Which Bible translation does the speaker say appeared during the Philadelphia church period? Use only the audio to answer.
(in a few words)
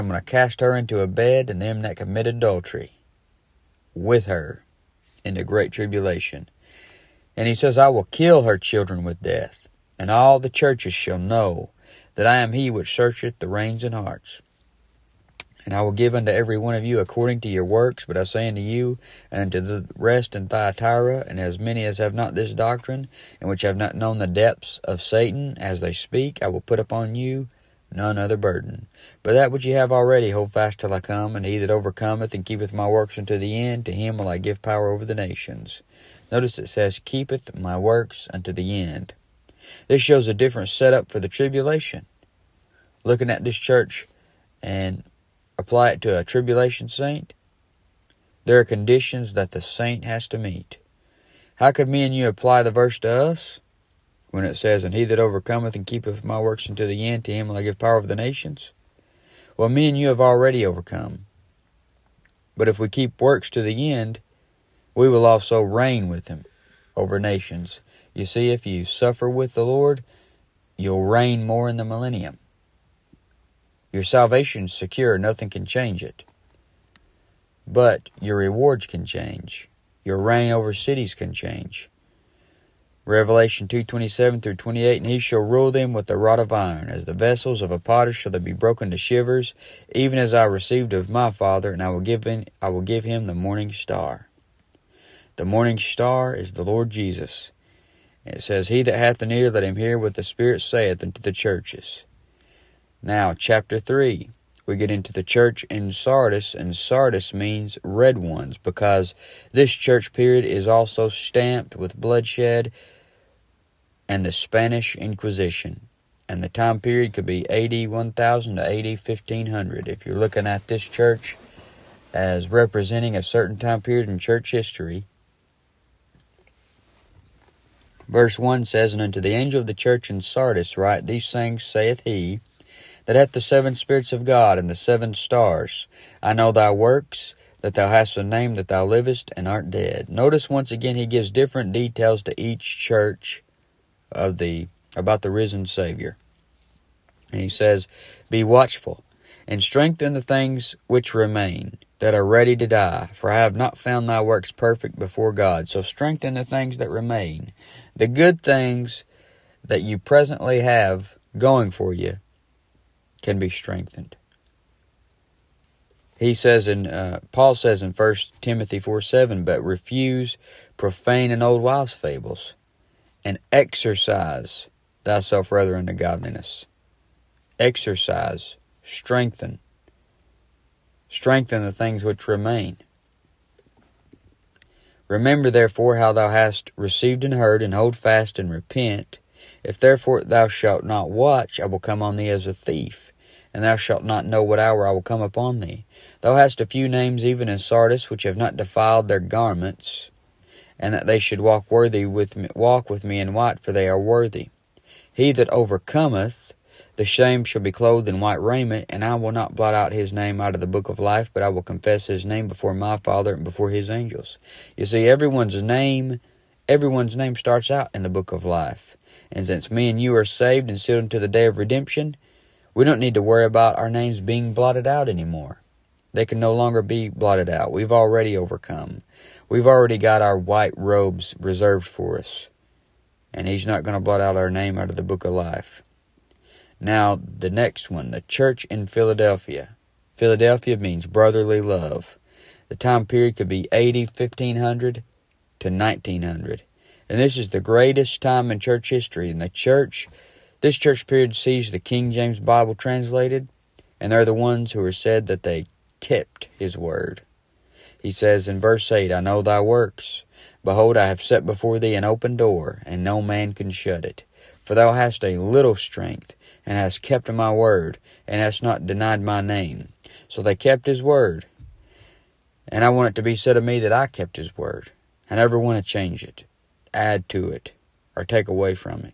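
King James Bible.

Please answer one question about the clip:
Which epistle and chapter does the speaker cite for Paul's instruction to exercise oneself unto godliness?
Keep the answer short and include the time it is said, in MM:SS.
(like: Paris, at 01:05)
First Timothy 4, at 02:47.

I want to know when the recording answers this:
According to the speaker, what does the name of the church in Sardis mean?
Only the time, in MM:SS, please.
01:47.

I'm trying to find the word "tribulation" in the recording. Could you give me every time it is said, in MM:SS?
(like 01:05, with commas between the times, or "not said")
00:05, 00:41, 00:46.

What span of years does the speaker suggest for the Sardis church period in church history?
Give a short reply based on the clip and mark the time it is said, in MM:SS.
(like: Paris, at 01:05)
AD 1000 to AD 1500, at 01:57.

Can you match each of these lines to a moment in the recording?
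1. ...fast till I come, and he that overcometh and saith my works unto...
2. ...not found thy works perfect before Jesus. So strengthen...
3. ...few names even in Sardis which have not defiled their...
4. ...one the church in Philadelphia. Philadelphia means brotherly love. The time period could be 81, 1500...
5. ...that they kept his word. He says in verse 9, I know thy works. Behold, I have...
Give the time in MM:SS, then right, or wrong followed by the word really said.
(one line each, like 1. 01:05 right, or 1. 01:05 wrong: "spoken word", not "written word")
1. 00:30 wrong: "keepeth", not "saith"
2. 02:33 wrong: "God", not "Jesus"
3. 03:16 right
4. 03:57 wrong: "80", not "81"
5. 04:15 wrong: "8", not "9".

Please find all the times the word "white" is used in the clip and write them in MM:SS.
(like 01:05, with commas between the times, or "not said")
03:23, 03:28, 03:50.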